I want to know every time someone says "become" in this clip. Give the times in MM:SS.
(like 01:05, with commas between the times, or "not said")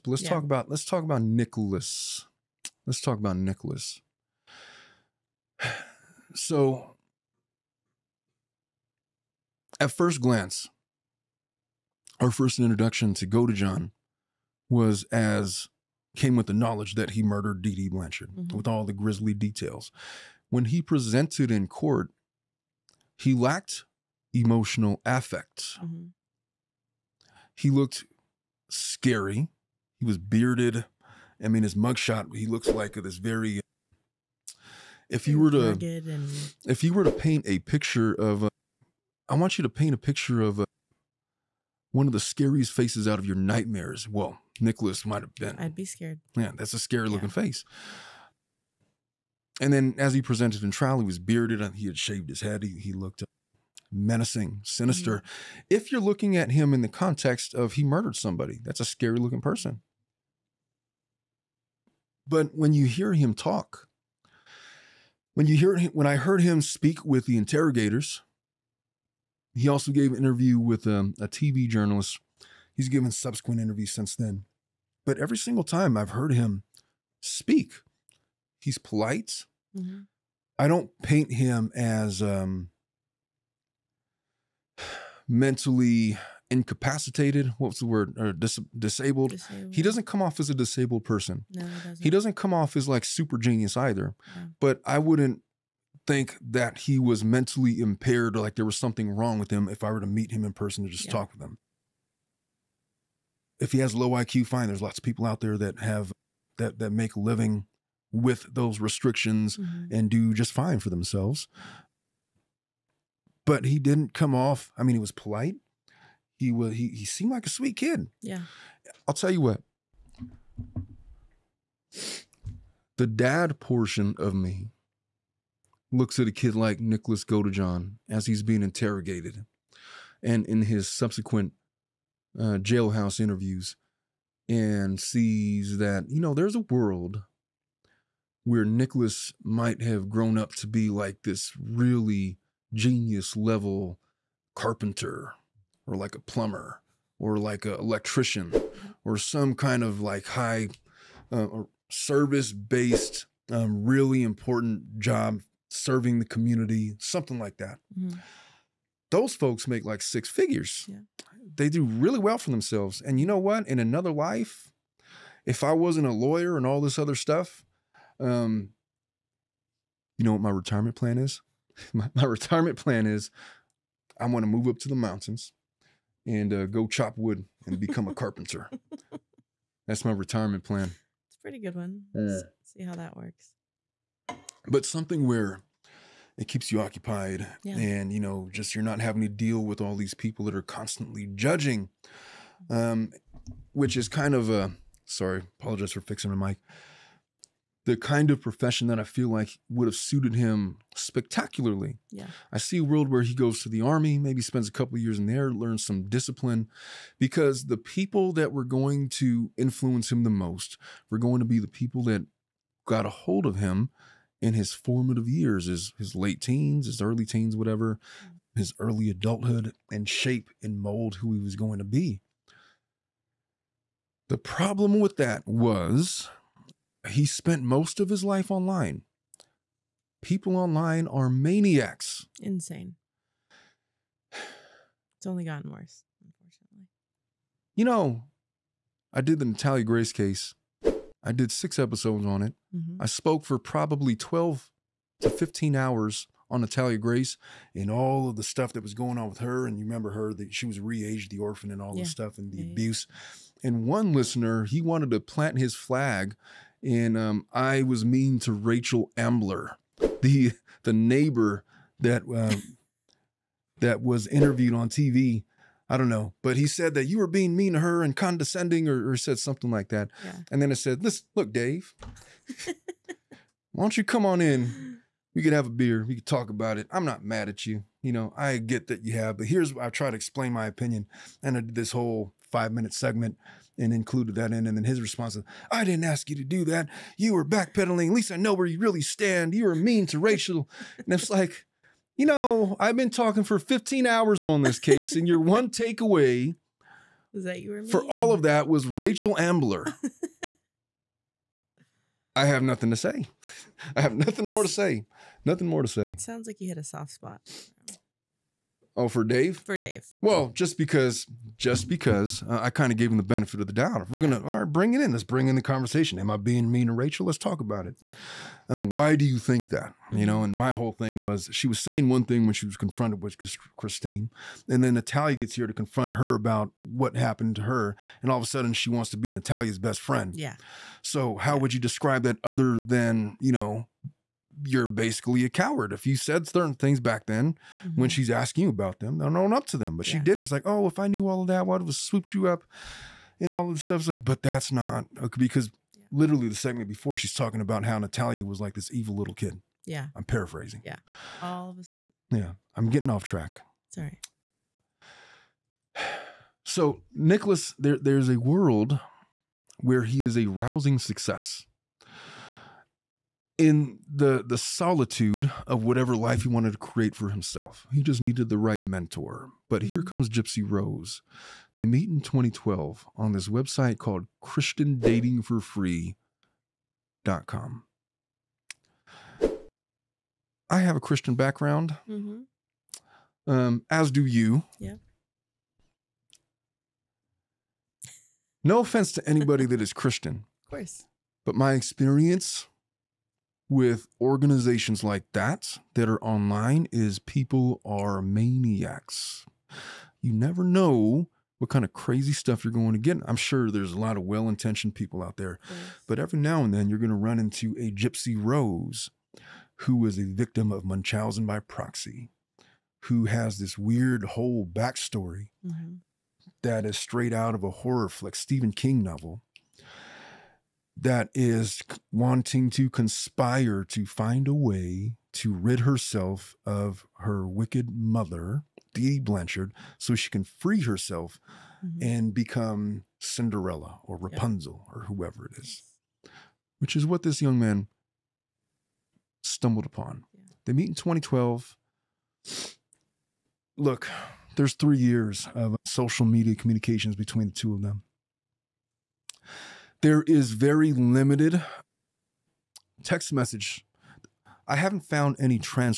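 02:57, 07:12.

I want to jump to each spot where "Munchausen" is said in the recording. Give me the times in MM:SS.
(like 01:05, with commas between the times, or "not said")
06:50.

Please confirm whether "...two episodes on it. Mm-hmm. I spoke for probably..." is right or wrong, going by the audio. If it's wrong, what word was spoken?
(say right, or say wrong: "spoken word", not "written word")
wrong: "six", not "two".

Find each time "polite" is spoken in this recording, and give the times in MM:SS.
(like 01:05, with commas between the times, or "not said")
01:18, 01:55.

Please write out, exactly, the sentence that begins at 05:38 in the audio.
when she's asking you about them don't own up to them but yeah.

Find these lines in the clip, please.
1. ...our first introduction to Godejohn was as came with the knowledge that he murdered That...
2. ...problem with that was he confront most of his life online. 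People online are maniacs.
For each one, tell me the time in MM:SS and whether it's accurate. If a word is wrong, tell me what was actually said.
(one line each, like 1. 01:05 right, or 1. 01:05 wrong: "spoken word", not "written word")
1. 00:12 wrong: "Dee", not "That"
2. 03:44 wrong: "spent", not "confront".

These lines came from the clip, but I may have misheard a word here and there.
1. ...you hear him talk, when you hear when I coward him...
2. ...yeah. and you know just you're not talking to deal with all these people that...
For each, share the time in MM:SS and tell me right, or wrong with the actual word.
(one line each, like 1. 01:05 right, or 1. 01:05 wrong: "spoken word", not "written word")
1. 01:02 wrong: "heard", not "coward"
2. 03:07 wrong: "having", not "talking".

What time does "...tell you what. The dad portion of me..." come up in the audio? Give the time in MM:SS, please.
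01:59.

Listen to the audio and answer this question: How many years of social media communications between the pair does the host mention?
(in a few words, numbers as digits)
3.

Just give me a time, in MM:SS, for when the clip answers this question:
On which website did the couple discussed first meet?
06:14.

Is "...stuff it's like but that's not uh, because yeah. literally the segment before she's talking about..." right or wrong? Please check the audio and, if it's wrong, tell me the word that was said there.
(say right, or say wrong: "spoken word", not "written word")
right.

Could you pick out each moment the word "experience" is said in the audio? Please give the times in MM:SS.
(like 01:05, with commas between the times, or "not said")
06:31.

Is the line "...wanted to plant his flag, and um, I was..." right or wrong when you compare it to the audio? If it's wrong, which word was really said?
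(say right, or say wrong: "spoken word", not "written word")
right.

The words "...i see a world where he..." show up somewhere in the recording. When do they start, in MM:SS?
03:22.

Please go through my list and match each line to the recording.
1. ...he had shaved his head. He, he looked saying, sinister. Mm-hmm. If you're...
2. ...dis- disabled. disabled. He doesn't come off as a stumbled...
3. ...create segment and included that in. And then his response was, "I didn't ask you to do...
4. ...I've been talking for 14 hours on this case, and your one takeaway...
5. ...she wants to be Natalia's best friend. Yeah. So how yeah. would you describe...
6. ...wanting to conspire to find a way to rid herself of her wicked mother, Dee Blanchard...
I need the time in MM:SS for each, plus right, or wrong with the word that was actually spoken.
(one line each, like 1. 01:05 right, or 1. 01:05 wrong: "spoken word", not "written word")
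1. 00:51 wrong: "menacing", not "saying"
2. 01:28 wrong: "disabled", not "stumbled"
3. 04:42 wrong: "minute", not "create"
4. 04:52 wrong: "15", not "14"
5. 05:28 right
6. 07:02 right.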